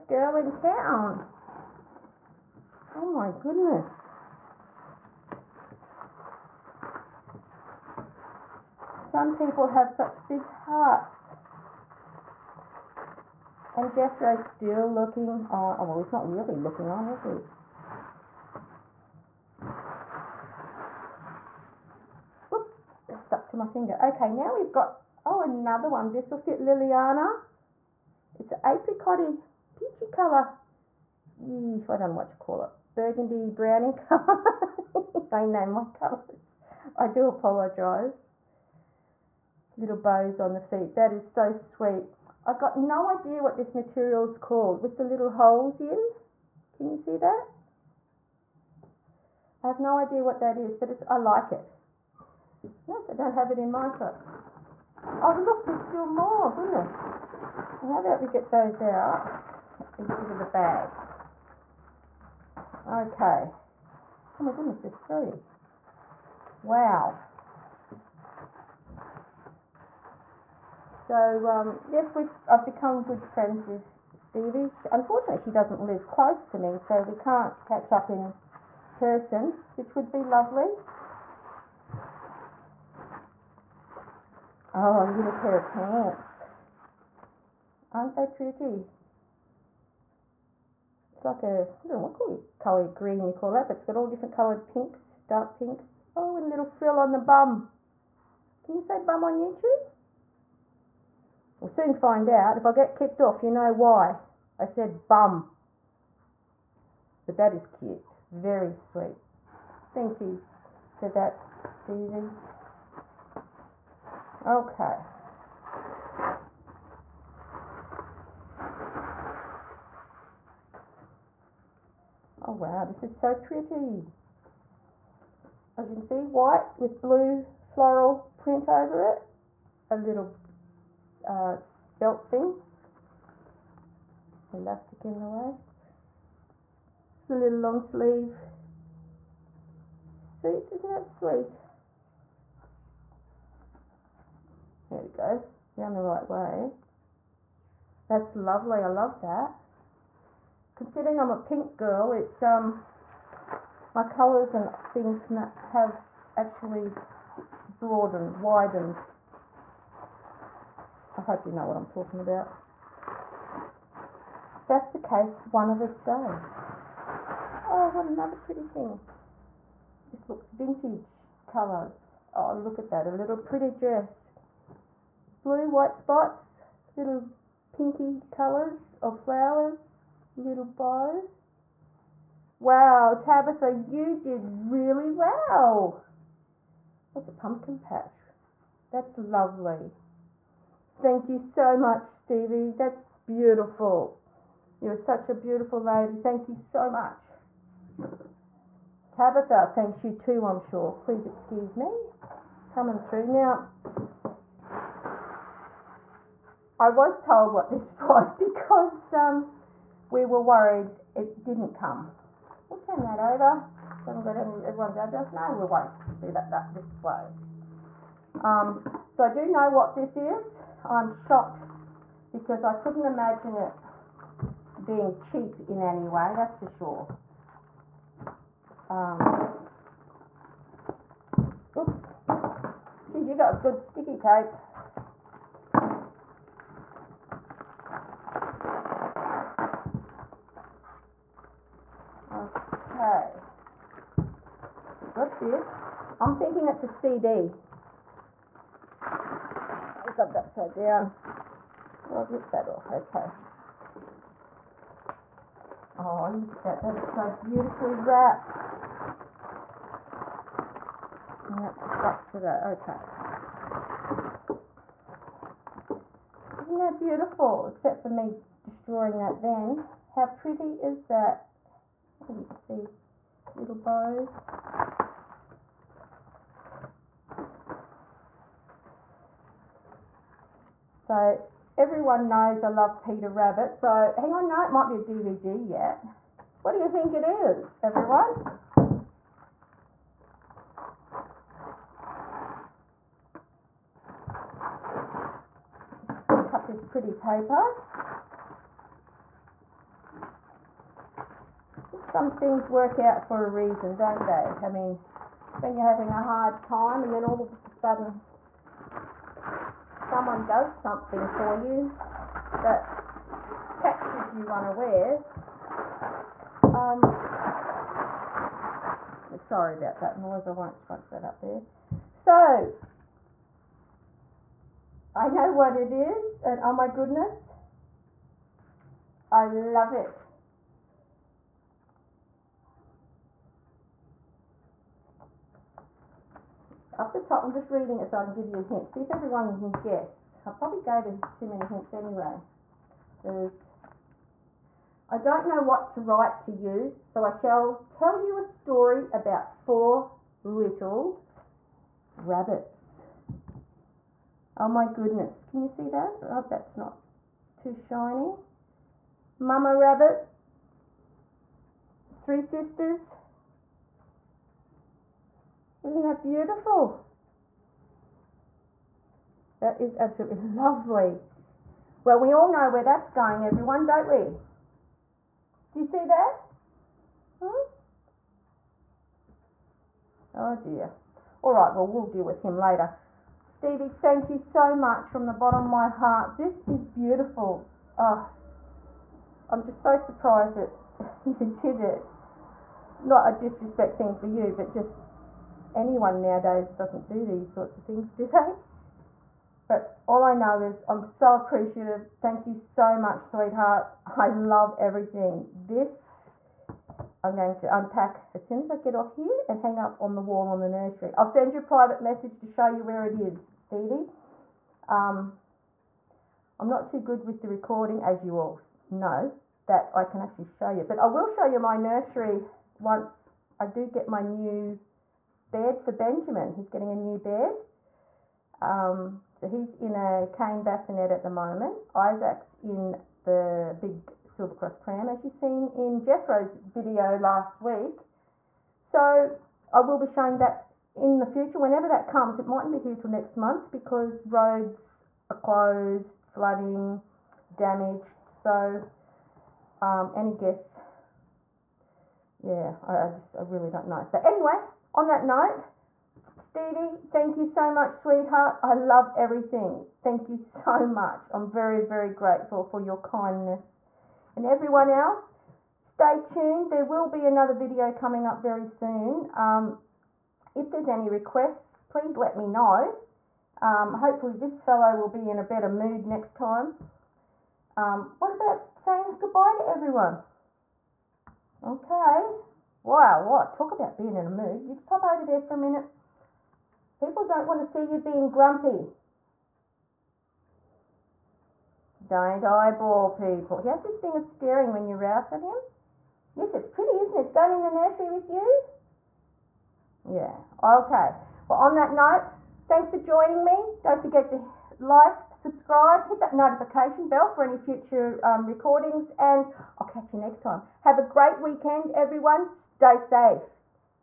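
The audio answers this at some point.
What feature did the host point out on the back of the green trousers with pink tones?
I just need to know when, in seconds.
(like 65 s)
96 s.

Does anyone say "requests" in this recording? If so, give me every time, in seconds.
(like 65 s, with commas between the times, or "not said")
471 s.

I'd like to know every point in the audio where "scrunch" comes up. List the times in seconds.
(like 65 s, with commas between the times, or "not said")
320 s.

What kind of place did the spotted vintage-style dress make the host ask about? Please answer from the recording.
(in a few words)
Pumpkin patch.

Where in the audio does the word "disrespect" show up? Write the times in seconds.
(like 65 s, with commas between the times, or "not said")
393 s.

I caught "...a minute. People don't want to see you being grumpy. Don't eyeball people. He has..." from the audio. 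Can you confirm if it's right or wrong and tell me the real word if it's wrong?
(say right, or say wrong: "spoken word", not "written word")
right.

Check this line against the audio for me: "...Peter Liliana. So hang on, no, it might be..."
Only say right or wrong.
wrong.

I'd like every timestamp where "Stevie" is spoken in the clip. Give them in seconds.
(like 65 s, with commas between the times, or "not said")
74 s, 111 s, 192 s, 383 s, 413 s, 456 s.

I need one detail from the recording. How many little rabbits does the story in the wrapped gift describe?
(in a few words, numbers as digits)
4.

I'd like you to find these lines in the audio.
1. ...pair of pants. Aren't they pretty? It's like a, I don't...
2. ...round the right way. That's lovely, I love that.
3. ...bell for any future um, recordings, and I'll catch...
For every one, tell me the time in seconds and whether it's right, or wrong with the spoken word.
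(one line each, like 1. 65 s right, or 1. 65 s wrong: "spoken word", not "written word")
1. 85 s right
2. 145 s right
3. 507 s right.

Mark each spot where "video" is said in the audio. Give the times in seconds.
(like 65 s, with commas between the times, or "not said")
436 s, 467 s.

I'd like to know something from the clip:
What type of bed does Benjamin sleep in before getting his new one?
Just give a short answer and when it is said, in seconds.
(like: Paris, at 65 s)
Cane bassinet, at 430 s.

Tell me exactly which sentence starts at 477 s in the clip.
Um, what about saying goodbye to everyone?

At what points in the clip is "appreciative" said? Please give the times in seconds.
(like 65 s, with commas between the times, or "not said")
401 s.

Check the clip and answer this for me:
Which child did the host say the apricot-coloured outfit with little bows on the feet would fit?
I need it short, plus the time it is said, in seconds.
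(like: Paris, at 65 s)
Liliana, at 26 s.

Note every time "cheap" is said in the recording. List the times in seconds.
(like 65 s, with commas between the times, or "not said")
225 s.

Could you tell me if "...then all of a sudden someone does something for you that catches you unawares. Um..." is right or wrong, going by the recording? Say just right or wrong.
right.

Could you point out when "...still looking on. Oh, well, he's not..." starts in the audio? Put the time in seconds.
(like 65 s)
14 s.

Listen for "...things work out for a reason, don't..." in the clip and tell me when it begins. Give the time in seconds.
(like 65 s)
302 s.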